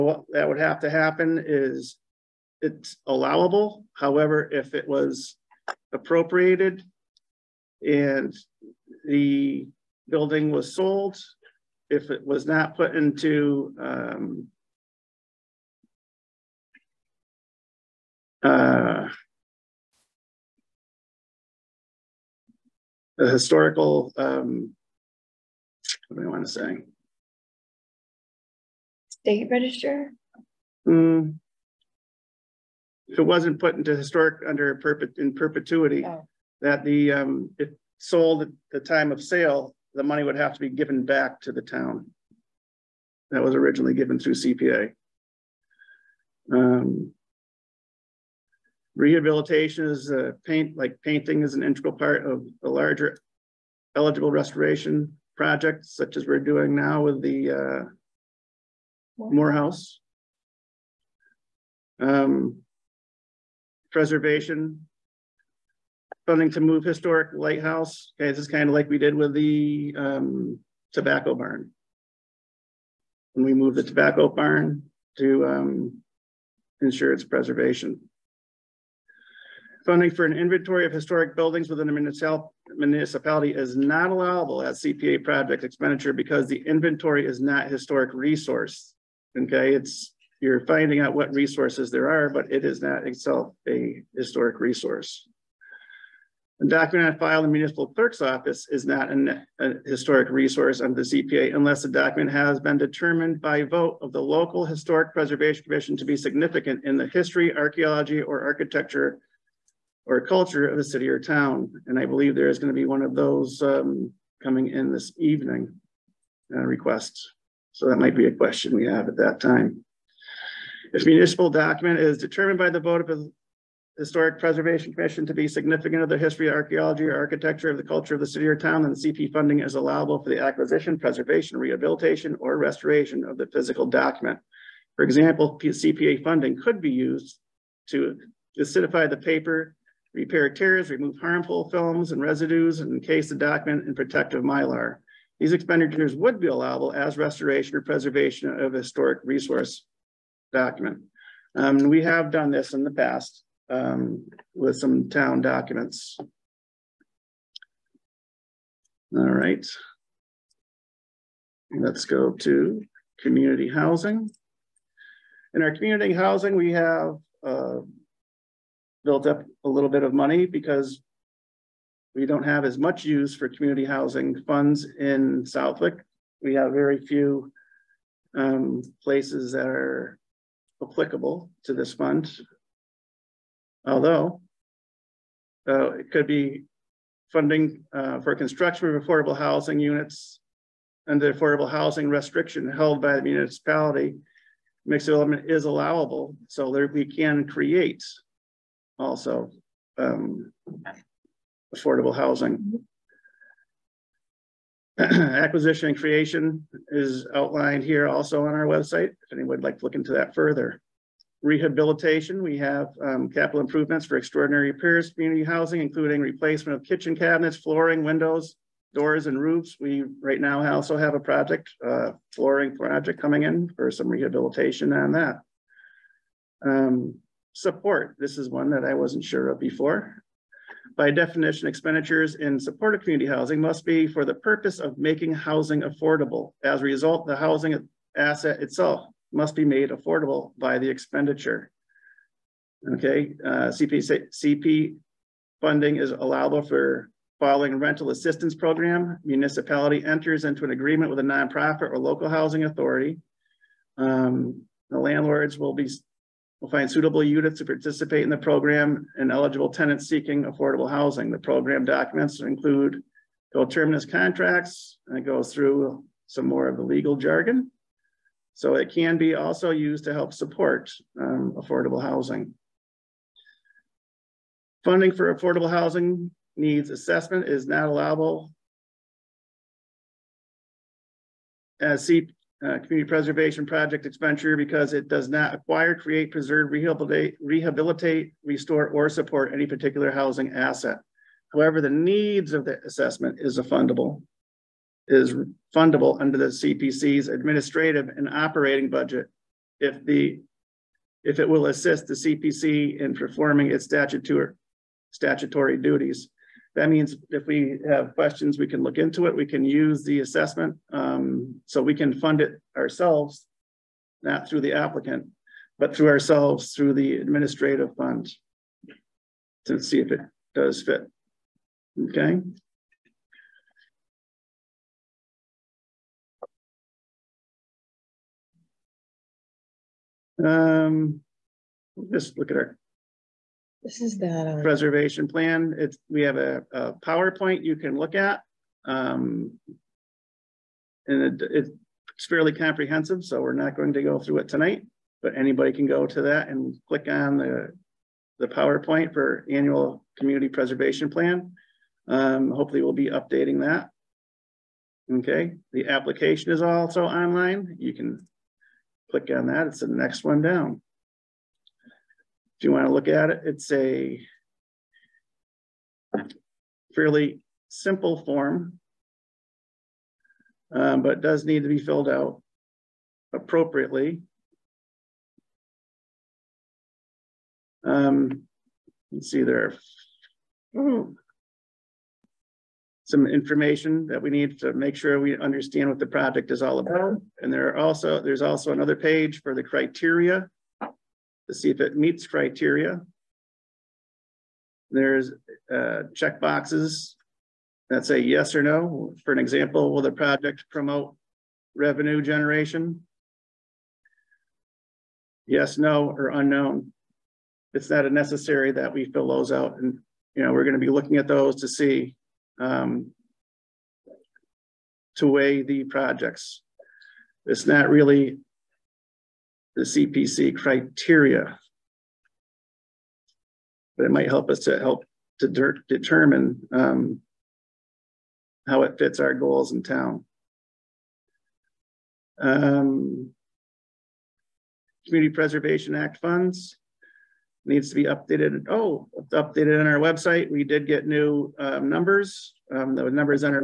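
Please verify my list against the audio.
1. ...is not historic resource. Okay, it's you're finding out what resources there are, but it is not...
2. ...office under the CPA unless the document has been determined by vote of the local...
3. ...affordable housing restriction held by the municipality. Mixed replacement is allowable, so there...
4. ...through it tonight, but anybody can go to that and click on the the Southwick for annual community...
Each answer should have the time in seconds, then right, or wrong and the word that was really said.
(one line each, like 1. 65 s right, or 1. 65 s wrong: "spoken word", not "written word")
1. 87 s right
2. 100 s wrong: "resource", not "office"
3. 191 s wrong: "development", not "replacement"
4. 344 s wrong: "PowerPoint", not "Southwick".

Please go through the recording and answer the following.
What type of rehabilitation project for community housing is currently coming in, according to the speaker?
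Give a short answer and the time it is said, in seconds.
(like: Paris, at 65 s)
Flooring project, at 222 s.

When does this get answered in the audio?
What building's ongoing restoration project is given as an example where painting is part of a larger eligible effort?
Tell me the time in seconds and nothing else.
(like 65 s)
59 s.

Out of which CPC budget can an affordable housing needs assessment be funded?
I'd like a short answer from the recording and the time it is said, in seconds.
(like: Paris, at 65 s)
Administrative and operating budget, at 297 s.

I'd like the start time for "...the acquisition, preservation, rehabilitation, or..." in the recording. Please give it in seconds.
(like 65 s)
130 s.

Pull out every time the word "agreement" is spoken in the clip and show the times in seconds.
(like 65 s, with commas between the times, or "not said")
250 s.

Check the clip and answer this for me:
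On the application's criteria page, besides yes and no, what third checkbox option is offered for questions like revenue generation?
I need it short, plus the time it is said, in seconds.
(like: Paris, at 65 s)
Unknown, at 406 s.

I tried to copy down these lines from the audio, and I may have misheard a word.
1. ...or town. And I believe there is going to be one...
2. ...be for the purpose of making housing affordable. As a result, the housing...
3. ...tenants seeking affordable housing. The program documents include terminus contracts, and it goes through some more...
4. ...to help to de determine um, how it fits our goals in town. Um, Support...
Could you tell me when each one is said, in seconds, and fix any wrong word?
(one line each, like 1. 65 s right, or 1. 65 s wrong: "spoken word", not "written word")
1. 111 s right
2. 233 s right
3. 259 s right
4. 424 s wrong: "Community", not "Support".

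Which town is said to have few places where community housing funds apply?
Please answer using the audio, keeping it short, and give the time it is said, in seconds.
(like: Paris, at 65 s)
Southwick, at 175 s.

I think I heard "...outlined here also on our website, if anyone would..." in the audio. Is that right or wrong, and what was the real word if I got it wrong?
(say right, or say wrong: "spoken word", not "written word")
right.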